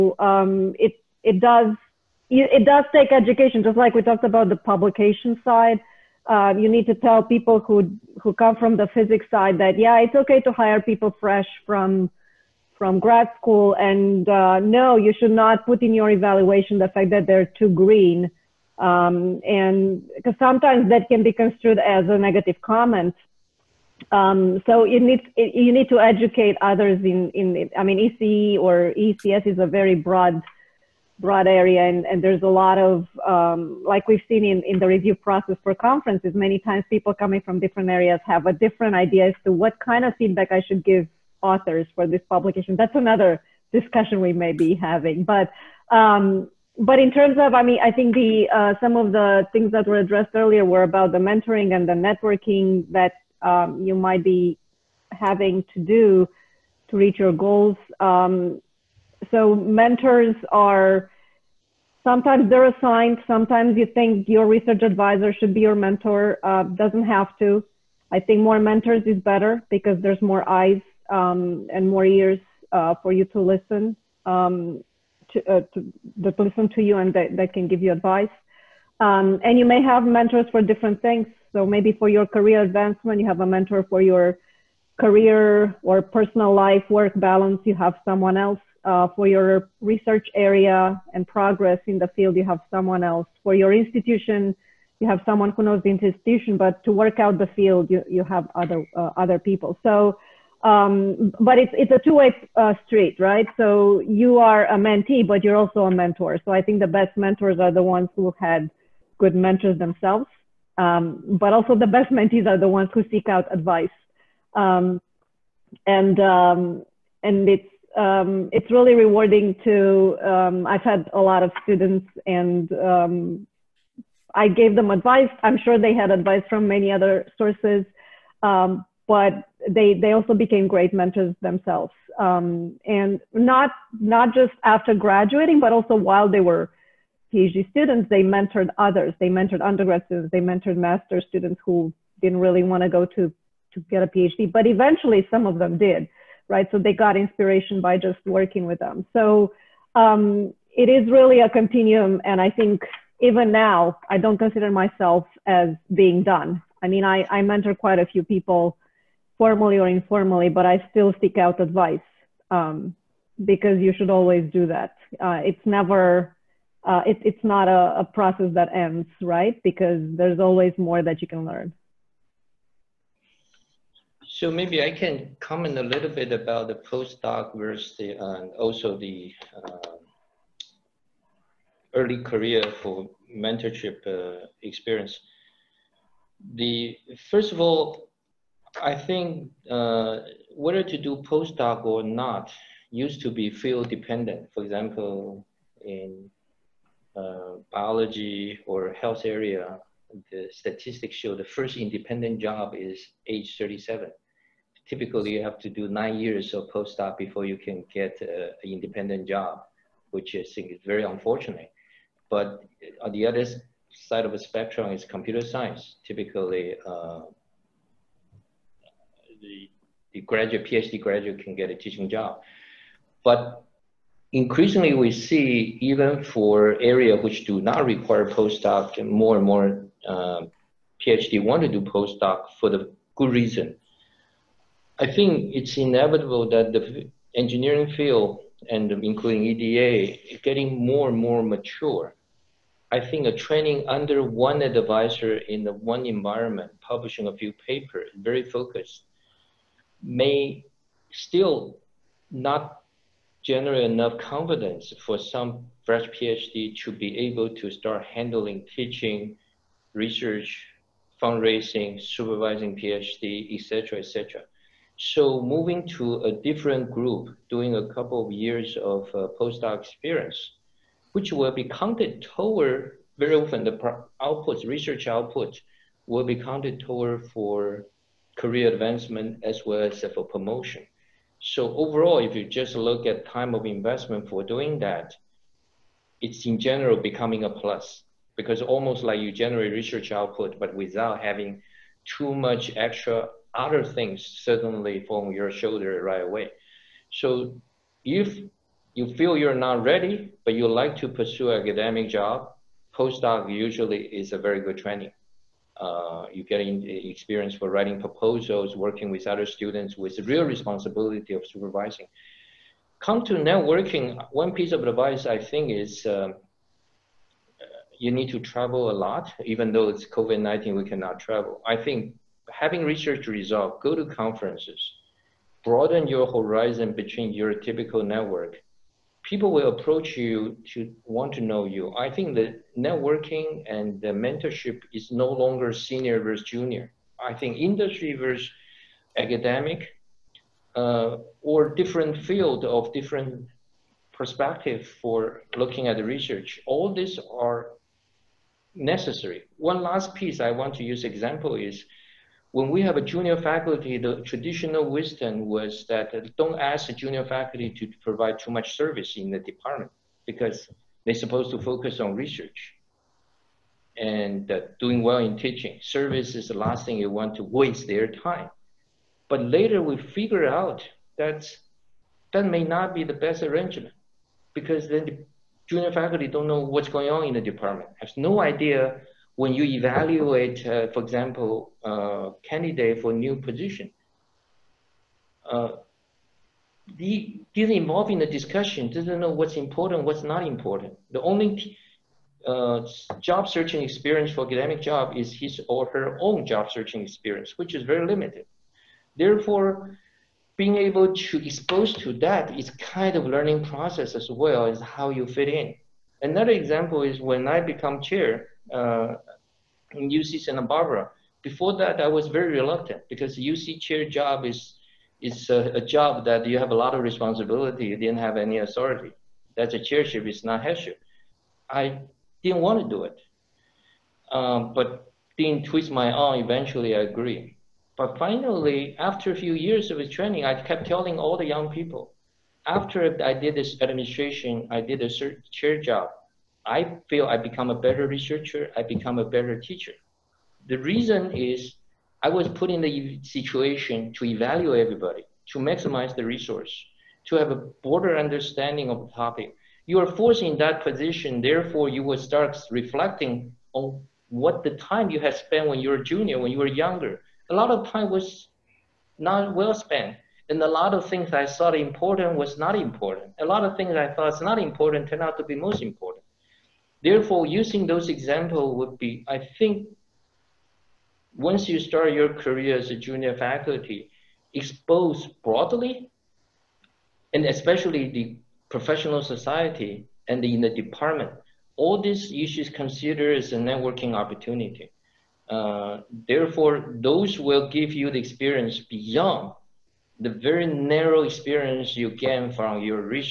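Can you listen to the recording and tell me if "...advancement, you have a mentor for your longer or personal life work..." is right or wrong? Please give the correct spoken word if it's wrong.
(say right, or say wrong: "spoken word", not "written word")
wrong: "career", not "longer".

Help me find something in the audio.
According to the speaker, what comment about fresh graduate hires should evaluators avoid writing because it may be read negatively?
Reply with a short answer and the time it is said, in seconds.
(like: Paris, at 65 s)
too green, at 17 s.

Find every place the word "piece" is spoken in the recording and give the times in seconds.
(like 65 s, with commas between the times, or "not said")
314 s, 350 s.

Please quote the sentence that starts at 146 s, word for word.
So they got inspiration by just working with them.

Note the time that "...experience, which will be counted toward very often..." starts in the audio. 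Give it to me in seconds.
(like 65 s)
269 s.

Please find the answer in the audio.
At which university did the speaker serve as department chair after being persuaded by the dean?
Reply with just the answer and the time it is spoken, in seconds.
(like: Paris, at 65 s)
UC Santa Barbara, at 410 s.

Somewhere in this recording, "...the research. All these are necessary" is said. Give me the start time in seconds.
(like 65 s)
345 s.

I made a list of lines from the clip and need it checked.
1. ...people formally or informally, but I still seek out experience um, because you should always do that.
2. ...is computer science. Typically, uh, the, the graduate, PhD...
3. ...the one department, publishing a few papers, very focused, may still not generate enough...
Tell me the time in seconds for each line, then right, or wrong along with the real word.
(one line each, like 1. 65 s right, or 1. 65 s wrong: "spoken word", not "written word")
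1. 158 s wrong: "advice", not "experience"
2. 214 s right
3. 245 s wrong: "environment", not "department".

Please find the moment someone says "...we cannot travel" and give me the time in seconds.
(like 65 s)
320 s.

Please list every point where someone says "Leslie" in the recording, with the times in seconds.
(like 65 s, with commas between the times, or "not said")
not said.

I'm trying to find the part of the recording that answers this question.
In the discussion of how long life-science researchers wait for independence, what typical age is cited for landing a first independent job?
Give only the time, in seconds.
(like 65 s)
203 s.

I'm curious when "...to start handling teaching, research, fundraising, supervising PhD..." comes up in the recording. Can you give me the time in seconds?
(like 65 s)
257 s.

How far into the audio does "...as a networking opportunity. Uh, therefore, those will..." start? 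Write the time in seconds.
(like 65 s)
483 s.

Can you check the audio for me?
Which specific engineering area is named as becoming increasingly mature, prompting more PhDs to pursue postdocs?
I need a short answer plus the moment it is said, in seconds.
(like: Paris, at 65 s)
EDA, at 239 s.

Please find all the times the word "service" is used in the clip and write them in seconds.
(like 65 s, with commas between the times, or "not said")
358 s, 365 s.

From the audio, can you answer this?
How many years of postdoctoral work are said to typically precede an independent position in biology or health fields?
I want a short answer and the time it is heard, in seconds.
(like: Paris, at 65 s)
9, at 205 s.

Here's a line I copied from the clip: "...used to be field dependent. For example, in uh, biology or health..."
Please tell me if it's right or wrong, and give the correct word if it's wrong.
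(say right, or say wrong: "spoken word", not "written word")
right.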